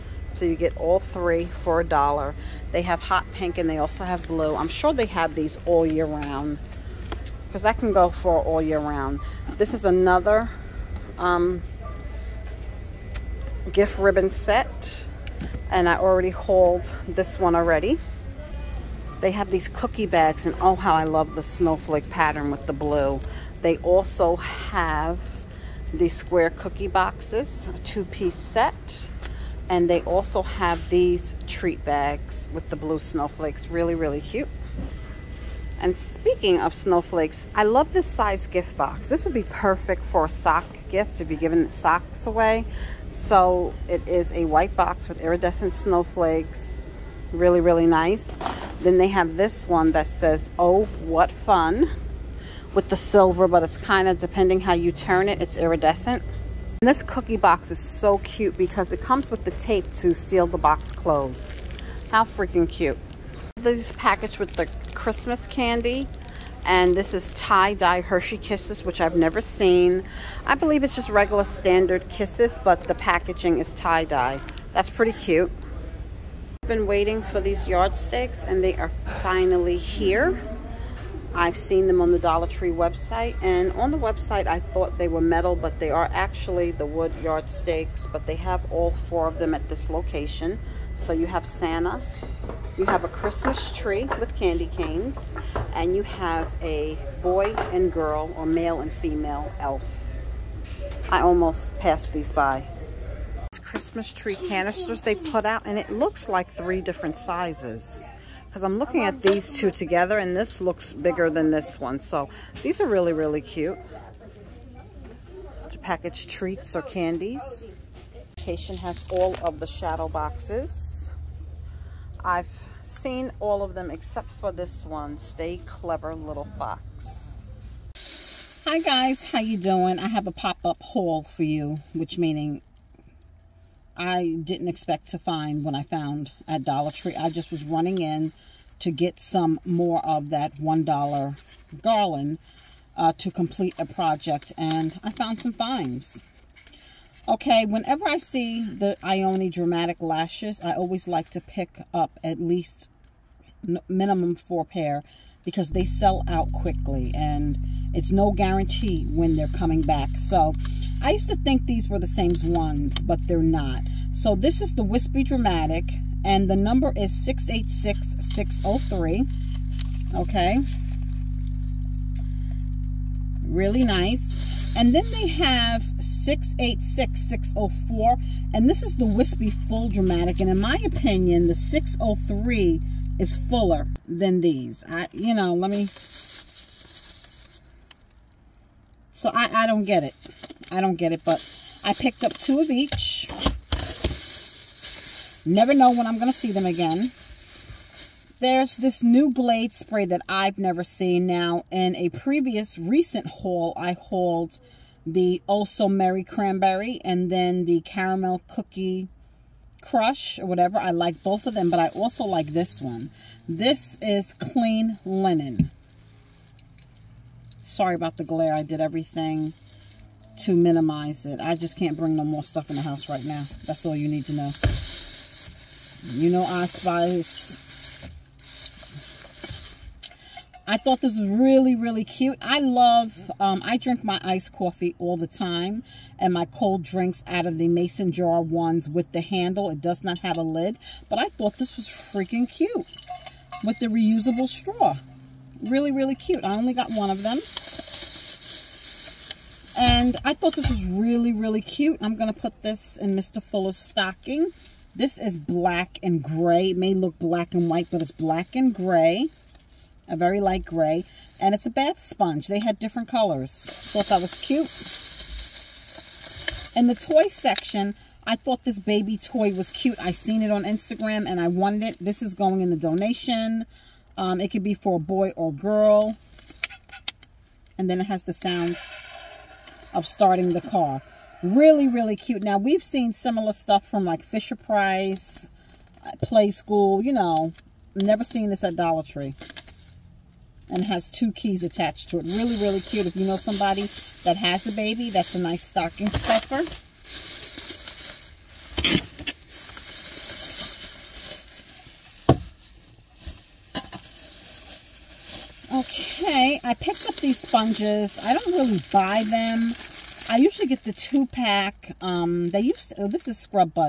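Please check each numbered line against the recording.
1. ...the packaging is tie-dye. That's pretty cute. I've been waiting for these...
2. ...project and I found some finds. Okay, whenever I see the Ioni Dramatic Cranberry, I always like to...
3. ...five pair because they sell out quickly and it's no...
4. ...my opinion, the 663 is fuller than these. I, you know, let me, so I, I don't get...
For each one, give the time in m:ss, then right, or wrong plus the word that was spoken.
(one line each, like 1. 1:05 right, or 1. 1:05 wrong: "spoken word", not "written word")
1. 1:12 right
2. 2:23 wrong: "Lashes", not "Cranberry"
3. 2:34 wrong: "four", not "five"
4. 3:00 wrong: "603", not "663".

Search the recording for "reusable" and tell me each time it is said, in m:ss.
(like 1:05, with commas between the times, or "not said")
4:03.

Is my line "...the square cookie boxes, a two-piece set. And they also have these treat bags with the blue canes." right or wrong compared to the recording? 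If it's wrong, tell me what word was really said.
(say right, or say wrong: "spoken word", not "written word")
wrong: "snowflakes", not "canes".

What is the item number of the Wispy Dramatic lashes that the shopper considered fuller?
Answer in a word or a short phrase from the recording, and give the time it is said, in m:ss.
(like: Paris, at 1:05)
686-603, at 2:47.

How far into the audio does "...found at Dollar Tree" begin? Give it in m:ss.
2:15.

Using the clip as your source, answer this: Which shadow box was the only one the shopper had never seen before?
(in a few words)
Stay Clever Little Fox.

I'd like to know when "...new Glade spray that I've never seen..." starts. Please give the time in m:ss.
3:19.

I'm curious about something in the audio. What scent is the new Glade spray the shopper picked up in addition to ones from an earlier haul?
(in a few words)
Clean Linen.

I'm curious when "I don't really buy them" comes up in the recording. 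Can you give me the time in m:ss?
5:08.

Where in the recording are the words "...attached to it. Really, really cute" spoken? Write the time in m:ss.
4:51.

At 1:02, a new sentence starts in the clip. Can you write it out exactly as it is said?
How freaking cute these package with the Christmas candy.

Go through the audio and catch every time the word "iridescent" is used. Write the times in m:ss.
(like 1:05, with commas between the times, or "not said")
0:45, 0:55.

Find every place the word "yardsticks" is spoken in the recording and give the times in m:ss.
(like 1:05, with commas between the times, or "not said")
1:17, 1:27.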